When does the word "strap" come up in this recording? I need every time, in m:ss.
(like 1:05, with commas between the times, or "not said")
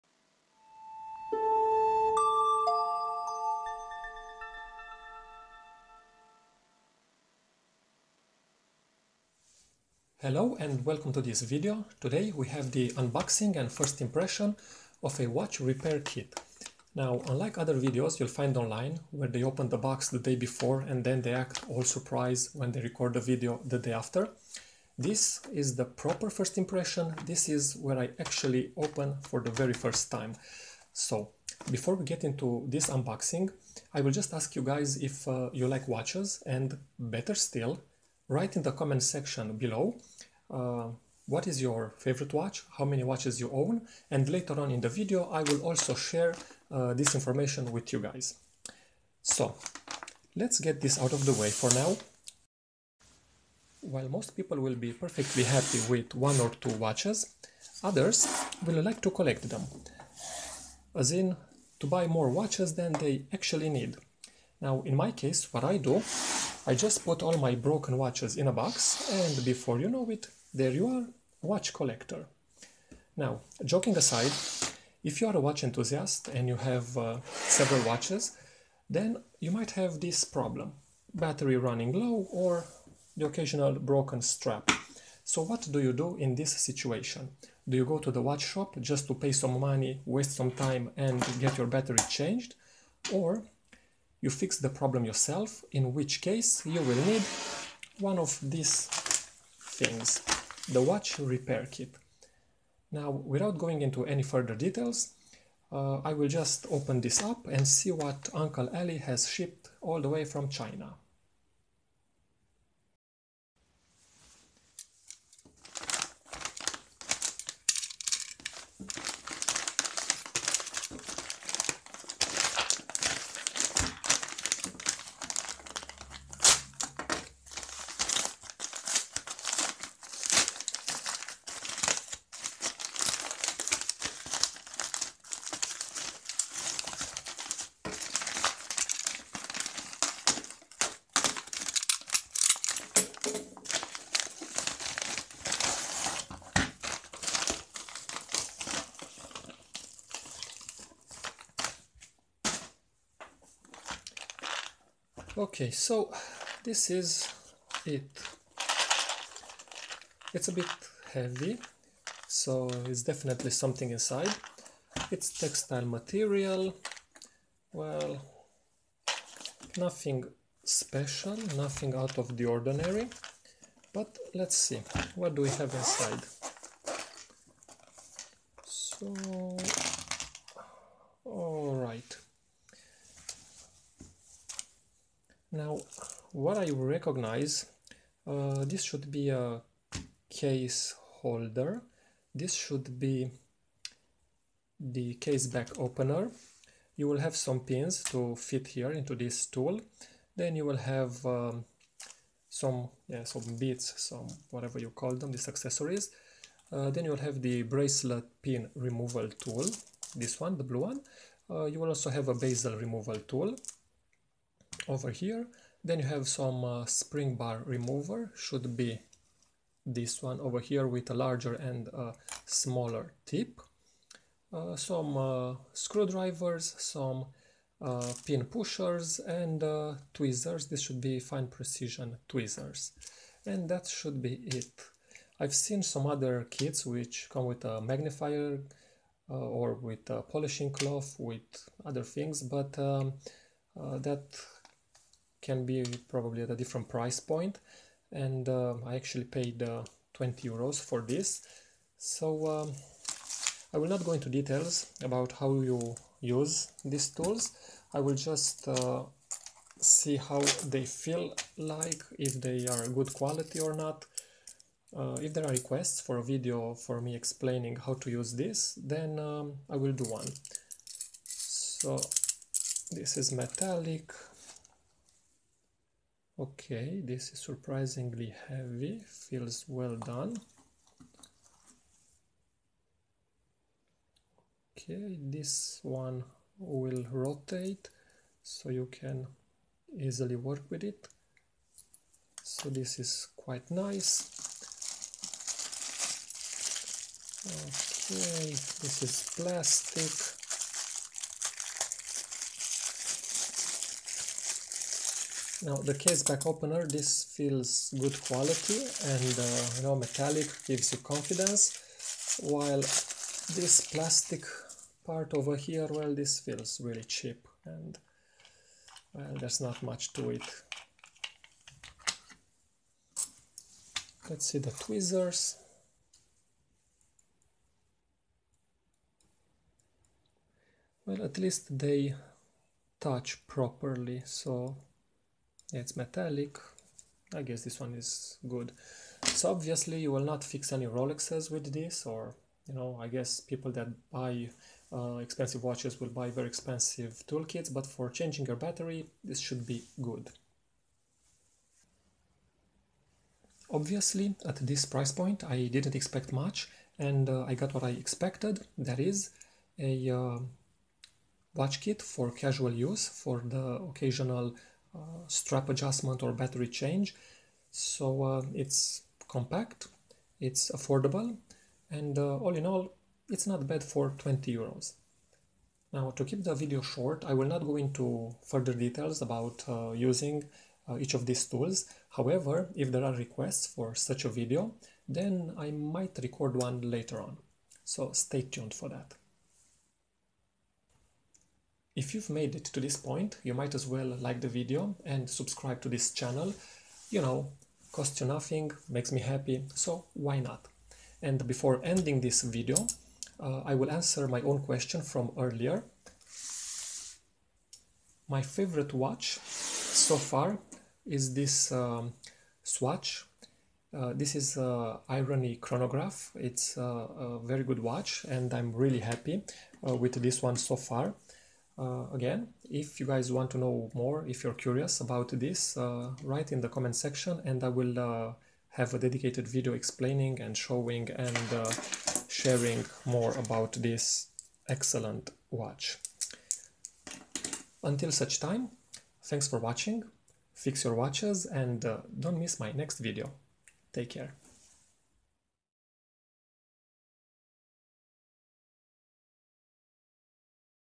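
1:24, 6:05.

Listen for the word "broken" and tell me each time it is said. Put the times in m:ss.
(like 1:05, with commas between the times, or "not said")
1:07, 1:23.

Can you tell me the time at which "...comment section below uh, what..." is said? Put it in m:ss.
0:38.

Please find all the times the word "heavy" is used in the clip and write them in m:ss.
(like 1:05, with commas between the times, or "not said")
2:41, 4:38.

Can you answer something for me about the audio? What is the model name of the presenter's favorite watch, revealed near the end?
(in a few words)
Irony Chronograph.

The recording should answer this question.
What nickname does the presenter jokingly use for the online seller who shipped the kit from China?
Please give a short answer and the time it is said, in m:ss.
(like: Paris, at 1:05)
Uncle Ali, at 1:48.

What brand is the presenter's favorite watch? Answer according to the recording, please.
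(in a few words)
Swatch.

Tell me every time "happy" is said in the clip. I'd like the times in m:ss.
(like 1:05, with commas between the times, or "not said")
0:55, 6:39, 6:58.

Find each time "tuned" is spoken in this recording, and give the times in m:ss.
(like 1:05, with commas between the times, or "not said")
6:28.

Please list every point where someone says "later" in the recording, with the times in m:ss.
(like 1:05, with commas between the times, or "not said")
0:44, 6:26.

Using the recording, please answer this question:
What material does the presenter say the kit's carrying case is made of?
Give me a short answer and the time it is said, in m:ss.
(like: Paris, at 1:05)
Textile, at 2:45.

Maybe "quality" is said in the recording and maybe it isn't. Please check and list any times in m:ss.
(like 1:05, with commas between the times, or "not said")
4:23, 5:08.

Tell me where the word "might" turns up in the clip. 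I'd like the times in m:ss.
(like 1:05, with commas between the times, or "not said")
1:19, 6:25, 6:33.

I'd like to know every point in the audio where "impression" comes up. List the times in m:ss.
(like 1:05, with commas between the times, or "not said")
0:14, 0:26.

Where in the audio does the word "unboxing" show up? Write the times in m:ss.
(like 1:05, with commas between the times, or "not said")
0:12, 0:32.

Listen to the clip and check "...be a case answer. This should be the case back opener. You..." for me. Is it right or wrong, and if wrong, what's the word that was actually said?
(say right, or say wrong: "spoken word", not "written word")
wrong: "holder", not "answer".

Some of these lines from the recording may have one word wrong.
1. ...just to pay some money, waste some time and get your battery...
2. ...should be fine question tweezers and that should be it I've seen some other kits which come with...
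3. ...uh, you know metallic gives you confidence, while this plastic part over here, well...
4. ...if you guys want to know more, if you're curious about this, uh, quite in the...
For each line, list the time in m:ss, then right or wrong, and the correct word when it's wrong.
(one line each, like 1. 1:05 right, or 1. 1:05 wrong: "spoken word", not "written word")
1. 1:28 right
2. 3:50 wrong: "precision", not "question"
3. 5:09 right
4. 7:02 wrong: "write", not "quite".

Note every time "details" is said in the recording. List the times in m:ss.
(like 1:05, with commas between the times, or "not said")
1:44, 4:14, 6:18.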